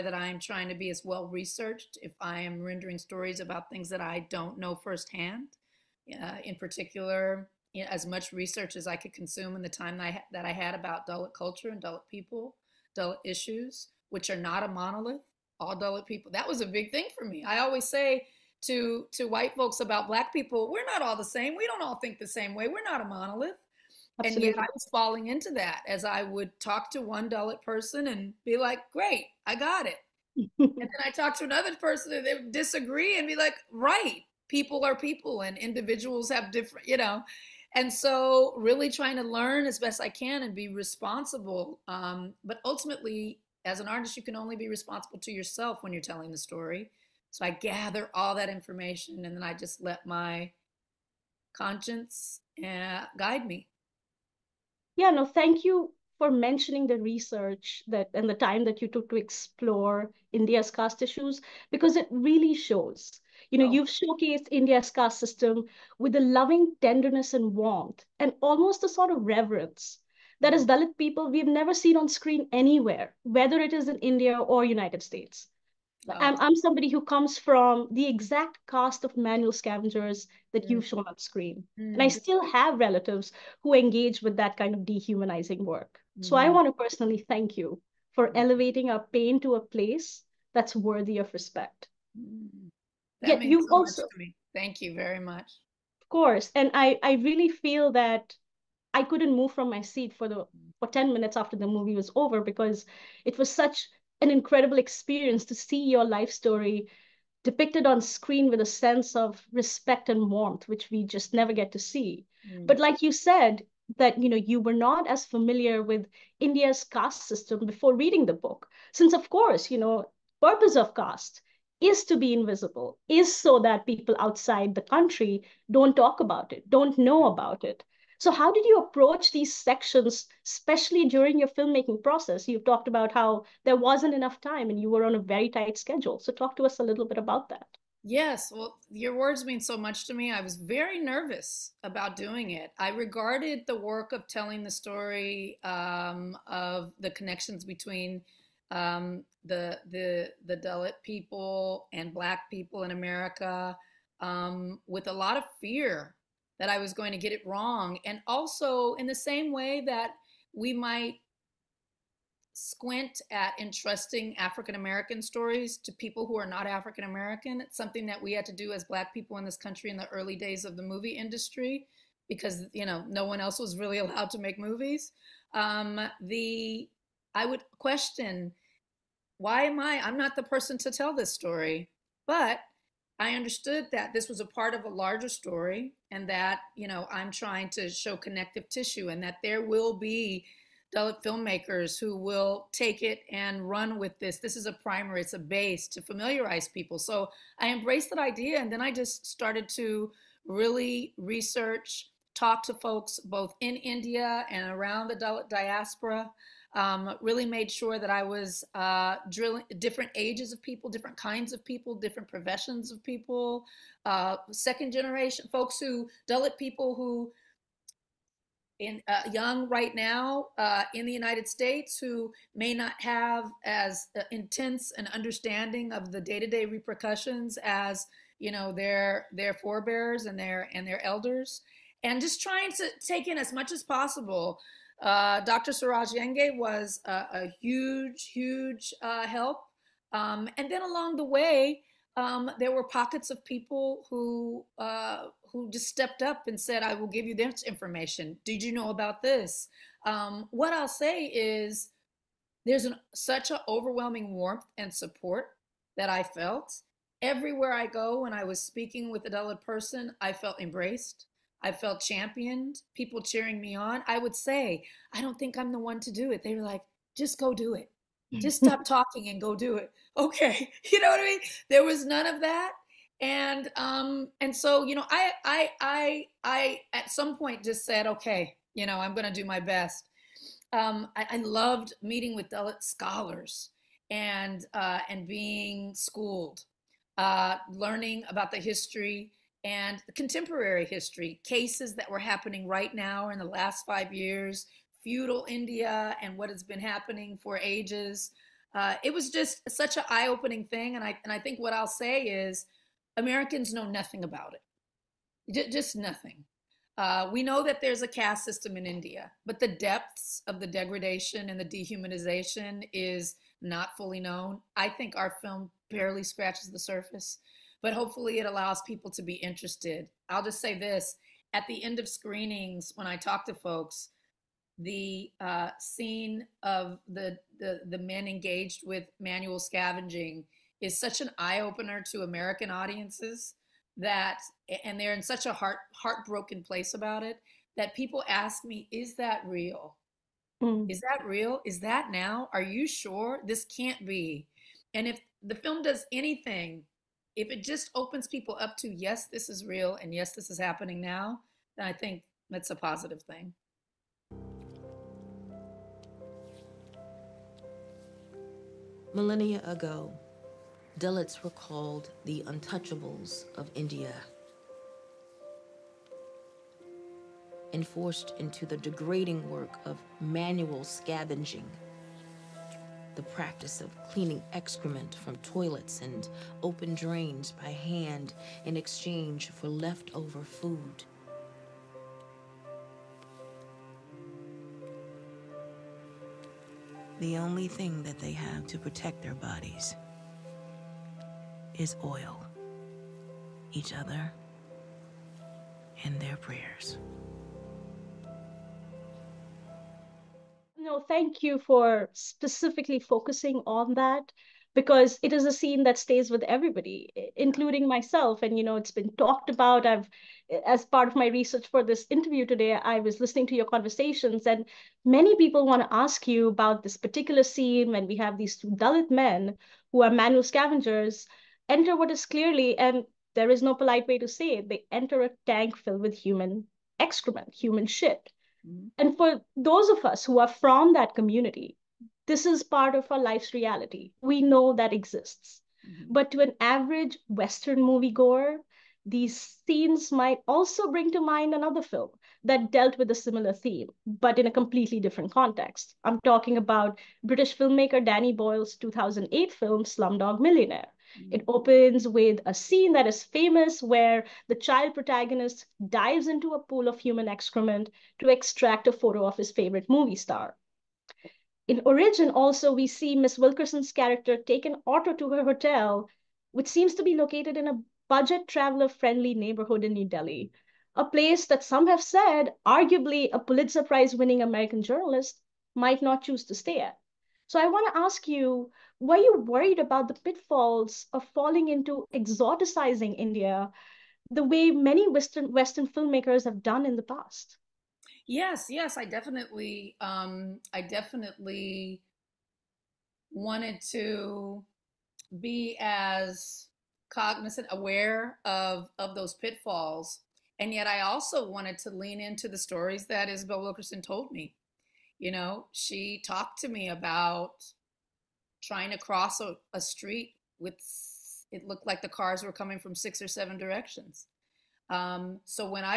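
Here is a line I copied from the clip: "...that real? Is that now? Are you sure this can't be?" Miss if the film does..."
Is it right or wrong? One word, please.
wrong.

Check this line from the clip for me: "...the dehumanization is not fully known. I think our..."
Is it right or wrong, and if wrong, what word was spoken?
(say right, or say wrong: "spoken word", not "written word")
right.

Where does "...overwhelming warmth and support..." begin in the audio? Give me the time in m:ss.
4:13.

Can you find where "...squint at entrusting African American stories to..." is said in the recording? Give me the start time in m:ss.
2:42.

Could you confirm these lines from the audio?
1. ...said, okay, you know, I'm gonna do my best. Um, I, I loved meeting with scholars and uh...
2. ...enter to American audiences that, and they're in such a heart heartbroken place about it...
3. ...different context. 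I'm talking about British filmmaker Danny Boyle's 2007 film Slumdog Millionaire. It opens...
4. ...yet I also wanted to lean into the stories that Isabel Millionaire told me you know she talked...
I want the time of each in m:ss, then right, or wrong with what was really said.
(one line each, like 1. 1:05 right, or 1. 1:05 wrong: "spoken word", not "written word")
1. 4:37 right
2. 5:31 wrong: "opener", not "enter"
3. 7:25 wrong: "2008", not "2007"
4. 8:20 wrong: "Wilkerson", not "Millionaire".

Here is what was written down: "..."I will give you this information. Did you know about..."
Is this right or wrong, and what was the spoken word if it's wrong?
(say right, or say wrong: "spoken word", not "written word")
right.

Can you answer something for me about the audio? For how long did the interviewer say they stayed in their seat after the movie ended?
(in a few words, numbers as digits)
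10 minutes.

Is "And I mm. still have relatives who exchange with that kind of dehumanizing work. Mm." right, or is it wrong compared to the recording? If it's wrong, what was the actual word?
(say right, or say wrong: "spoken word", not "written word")
wrong: "engage", not "exchange".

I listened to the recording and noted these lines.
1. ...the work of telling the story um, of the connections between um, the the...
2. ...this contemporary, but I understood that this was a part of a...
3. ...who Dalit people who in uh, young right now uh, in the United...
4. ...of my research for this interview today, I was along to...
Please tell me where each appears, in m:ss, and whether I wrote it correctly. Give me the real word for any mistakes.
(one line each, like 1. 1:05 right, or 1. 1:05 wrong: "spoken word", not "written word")
1. 2:23 right
2. 3:01 wrong: "story", not "contemporary"
3. 3:35 right
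4. 6:51 wrong: "listening", not "along".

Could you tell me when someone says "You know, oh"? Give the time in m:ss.
1:03.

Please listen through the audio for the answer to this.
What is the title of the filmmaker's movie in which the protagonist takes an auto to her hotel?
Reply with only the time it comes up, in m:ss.
7:41.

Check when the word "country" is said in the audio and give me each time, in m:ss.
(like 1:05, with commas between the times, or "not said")
2:04, 2:49.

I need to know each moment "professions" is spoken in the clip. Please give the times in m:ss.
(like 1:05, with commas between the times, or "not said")
3:32.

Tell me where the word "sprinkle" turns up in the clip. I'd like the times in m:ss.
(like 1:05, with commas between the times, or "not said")
not said.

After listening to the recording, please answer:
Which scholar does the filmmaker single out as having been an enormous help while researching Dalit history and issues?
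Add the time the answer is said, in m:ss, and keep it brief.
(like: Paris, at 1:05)
Dr. Suraj Yengde, at 3:55.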